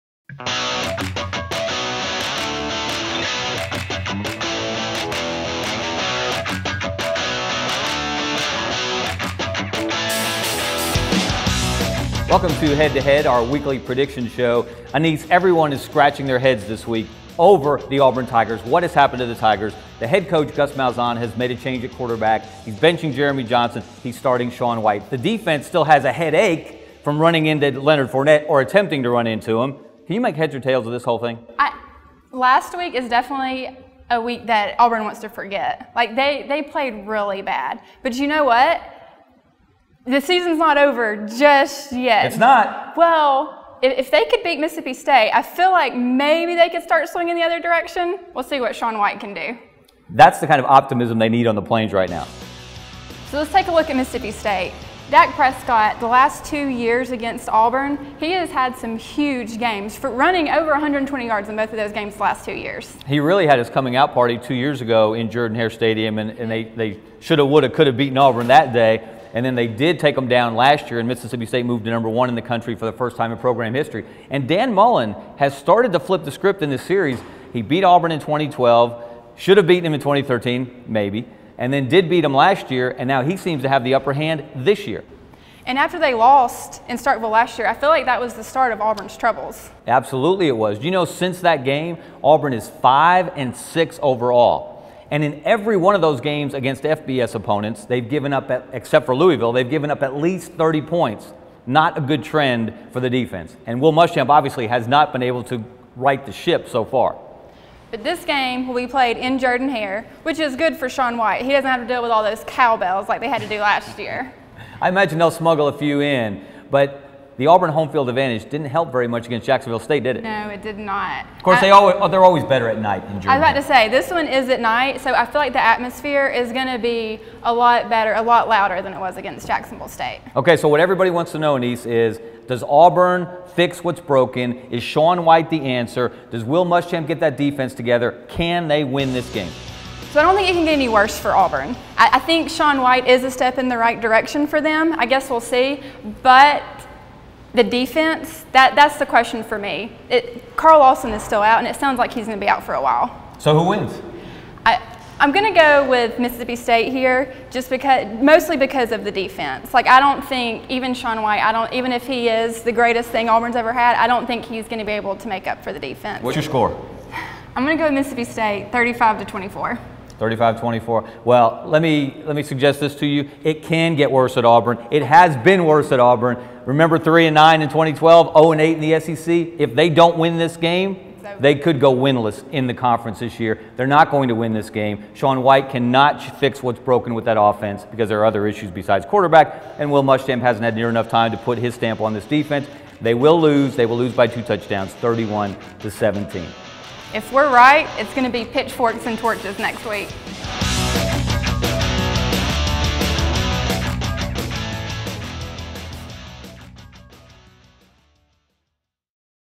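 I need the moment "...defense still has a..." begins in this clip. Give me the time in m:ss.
0:25.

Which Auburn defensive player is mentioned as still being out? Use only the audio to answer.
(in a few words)
Carl Lawson.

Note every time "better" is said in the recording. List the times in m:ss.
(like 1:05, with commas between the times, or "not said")
2:02, 2:07.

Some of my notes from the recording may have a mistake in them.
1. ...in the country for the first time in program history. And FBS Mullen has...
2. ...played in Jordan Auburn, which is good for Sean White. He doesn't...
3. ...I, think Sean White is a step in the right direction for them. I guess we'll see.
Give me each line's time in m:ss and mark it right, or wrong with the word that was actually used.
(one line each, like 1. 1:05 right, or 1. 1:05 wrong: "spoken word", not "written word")
1. 1:12 wrong: "Dan", not "FBS"
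2. 1:48 wrong: "Hare", not "Auburn"
3. 2:22 right.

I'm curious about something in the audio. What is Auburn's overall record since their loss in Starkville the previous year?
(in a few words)
5 and 6.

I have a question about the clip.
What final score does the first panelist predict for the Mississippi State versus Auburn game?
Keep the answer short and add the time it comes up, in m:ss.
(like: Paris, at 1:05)
35 to 24, at 2:48.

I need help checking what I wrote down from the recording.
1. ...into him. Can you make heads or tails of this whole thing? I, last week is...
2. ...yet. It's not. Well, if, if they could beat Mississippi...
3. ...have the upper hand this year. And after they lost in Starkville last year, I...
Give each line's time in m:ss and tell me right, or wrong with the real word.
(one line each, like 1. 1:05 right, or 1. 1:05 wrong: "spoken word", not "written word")
1. 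0:29 right
2. 0:41 right
3. 1:23 right.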